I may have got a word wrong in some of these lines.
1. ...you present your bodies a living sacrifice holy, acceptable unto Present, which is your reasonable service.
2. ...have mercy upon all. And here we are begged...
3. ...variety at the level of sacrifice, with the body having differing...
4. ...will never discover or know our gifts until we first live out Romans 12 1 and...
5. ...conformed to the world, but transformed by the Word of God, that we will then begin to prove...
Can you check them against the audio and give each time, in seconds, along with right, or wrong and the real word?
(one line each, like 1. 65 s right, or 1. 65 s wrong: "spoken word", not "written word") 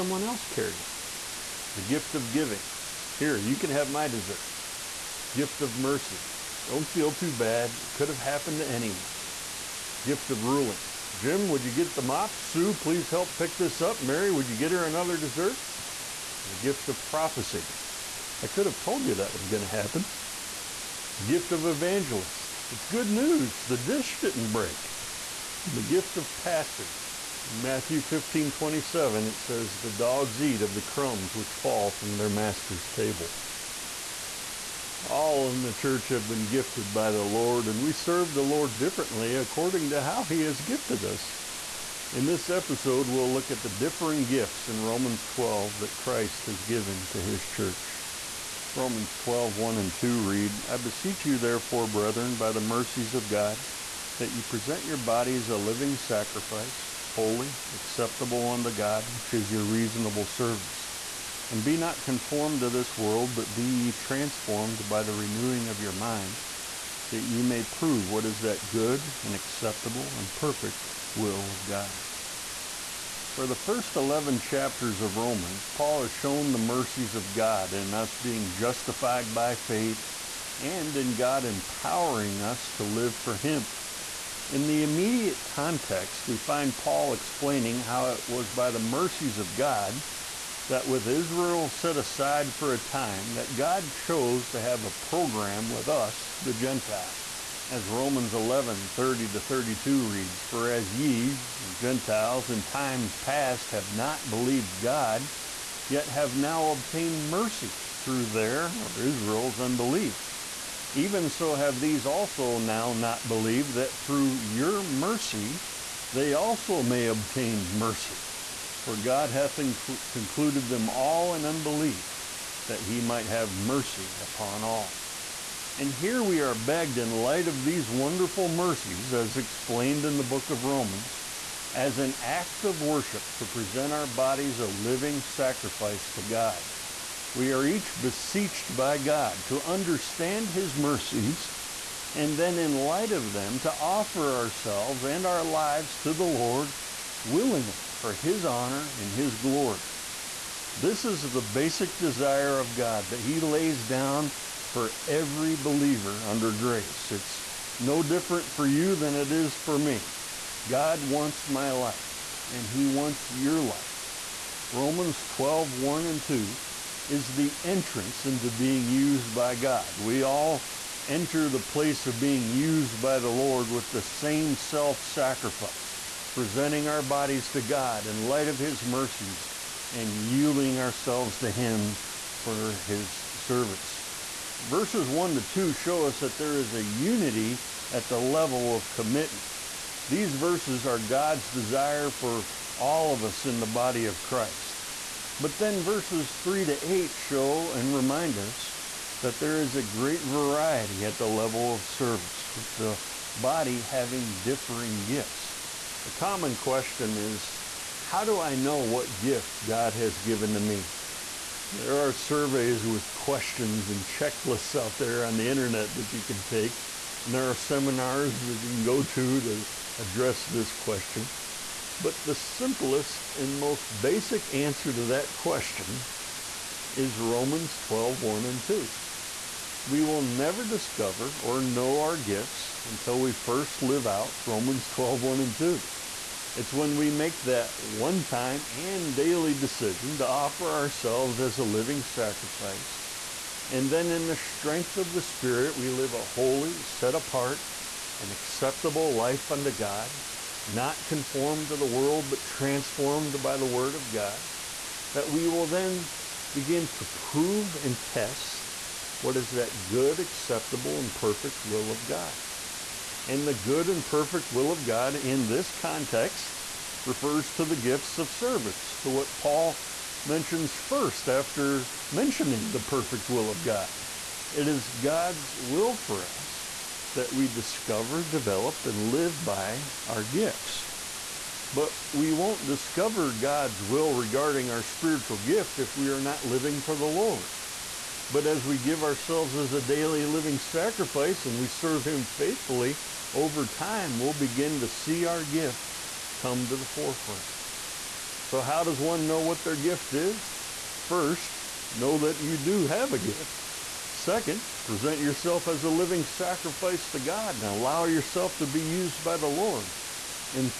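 1. 54 s wrong: "God", not "Present"
2. 123 s right
3. 200 s wrong: "service", not "sacrifice"
4. 230 s right
5. 251 s right.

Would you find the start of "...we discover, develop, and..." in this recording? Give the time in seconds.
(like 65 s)
277 s.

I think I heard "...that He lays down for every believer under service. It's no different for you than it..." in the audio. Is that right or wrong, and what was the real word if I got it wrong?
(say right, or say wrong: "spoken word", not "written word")
wrong: "grace", not "service".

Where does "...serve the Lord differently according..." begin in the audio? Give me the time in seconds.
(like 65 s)
37 s.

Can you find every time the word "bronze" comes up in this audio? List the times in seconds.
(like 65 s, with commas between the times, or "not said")
not said.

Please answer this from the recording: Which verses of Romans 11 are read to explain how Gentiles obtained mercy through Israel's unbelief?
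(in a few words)
30 to 32.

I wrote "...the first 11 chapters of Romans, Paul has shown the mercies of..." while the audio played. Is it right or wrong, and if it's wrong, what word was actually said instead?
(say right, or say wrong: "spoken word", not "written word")
right.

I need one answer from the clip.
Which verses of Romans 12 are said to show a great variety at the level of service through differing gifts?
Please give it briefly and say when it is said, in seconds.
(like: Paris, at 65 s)
3 to 8, at 196 s.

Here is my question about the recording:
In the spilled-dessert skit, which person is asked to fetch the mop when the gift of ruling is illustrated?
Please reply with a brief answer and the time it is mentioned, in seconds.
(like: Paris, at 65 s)
Jim, at 11 s.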